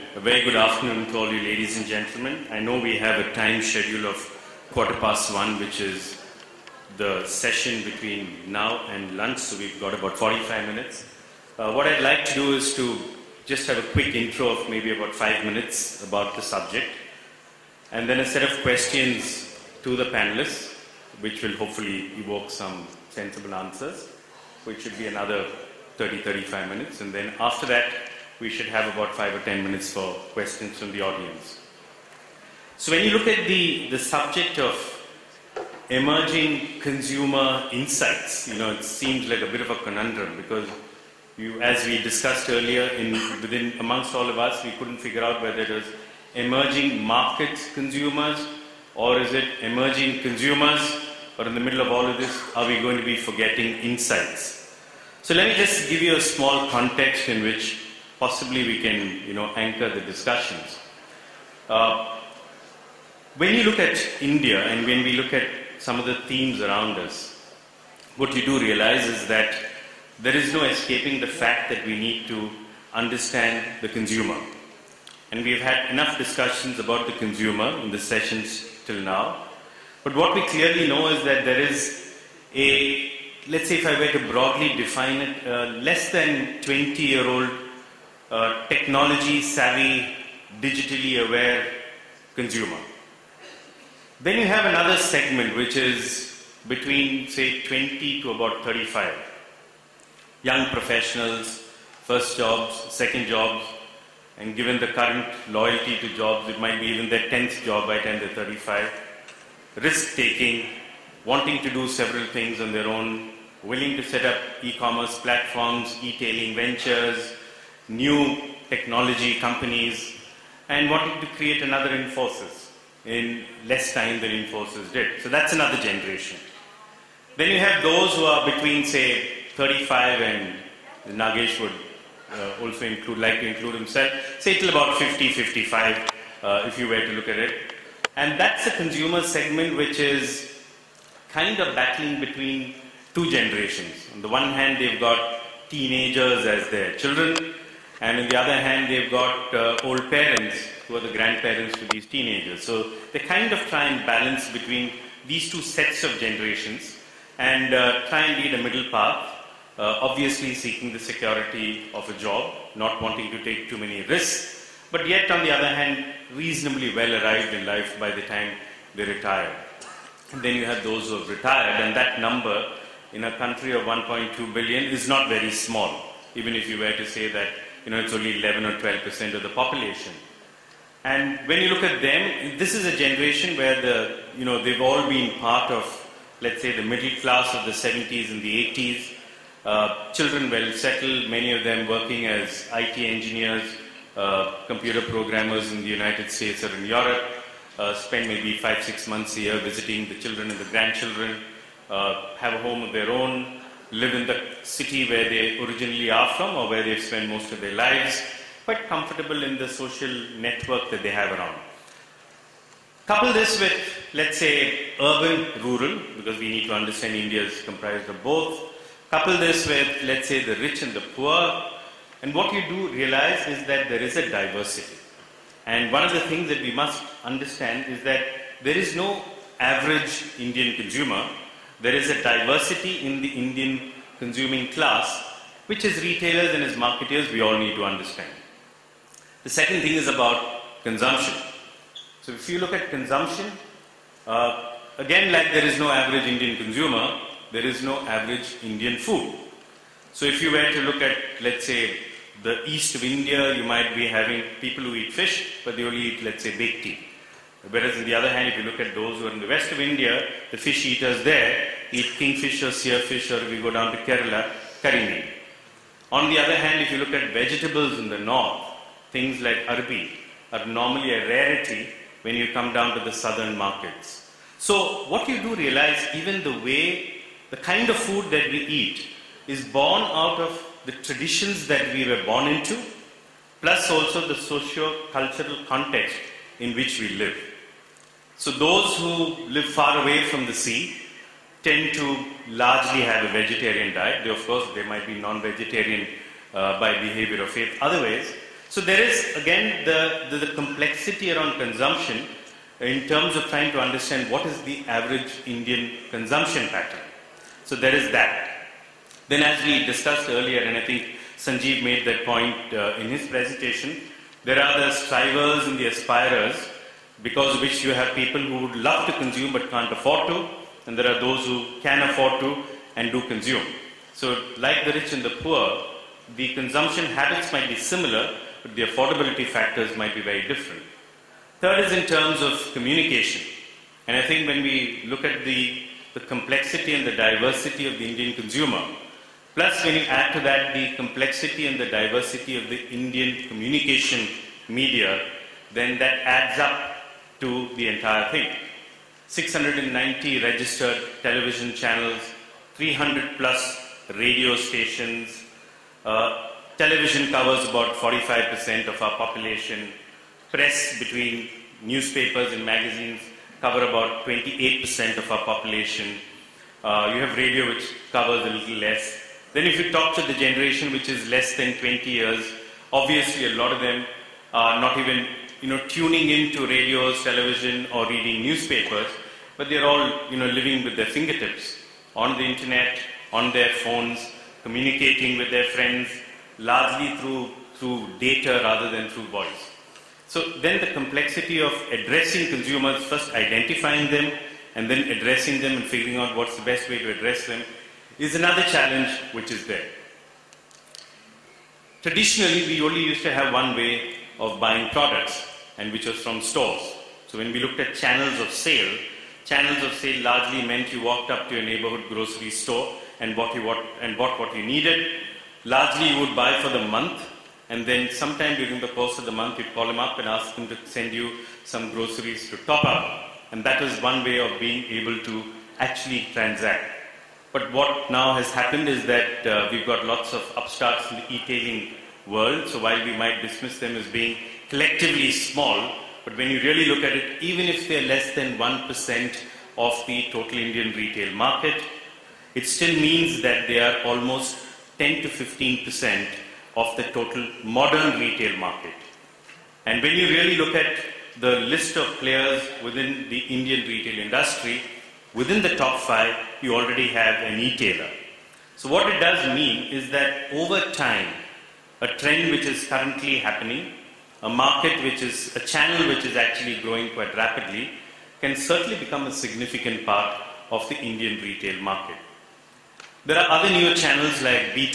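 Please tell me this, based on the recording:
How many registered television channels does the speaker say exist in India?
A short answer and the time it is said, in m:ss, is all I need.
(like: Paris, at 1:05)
690, at 5:49.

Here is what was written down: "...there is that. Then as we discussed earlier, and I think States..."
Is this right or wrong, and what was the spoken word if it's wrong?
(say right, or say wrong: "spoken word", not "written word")
wrong: "Sanjeev", not "States".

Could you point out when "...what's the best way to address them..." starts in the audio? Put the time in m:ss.
6:36.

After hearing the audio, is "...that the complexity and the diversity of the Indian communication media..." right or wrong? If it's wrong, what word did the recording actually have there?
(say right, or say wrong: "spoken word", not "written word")
right.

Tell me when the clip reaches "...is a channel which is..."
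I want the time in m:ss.
7:45.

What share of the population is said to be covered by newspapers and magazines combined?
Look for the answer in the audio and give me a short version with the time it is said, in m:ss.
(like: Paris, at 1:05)
28%, at 6:04.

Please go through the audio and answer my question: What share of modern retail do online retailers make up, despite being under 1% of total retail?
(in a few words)
10 to 15%.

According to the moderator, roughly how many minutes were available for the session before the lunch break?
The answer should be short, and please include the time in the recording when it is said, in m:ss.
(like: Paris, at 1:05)
45 minutes, at 0:10.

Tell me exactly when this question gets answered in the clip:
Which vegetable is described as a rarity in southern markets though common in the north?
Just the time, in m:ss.
4:29.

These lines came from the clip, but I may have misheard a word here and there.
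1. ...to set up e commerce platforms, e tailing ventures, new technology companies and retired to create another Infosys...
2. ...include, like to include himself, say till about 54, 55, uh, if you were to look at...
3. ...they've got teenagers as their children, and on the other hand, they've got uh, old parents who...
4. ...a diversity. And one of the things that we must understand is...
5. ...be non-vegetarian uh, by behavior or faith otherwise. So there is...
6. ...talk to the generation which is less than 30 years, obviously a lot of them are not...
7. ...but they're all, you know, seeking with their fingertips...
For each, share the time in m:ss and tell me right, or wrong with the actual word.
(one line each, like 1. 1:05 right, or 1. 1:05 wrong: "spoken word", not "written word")
1. 1:53 wrong: "wanted", not "retired"
2. 2:12 wrong: "50", not "54"
3. 2:24 right
4. 3:44 right
5. 4:55 right
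6. 6:09 wrong: "20", not "30"
7. 6:19 wrong: "living", not "seeking".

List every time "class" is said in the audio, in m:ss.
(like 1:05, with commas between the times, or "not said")
3:07, 3:54.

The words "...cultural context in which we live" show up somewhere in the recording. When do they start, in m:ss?
4:45.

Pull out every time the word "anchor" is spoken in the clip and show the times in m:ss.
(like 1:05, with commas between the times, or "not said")
0:59.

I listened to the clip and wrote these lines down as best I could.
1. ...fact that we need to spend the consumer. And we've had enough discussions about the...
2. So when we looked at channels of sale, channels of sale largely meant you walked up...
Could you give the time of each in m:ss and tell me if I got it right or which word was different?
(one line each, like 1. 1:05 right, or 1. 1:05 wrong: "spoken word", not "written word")
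1. 1:11 wrong: "understand", not "spend"
2. 6:47 right.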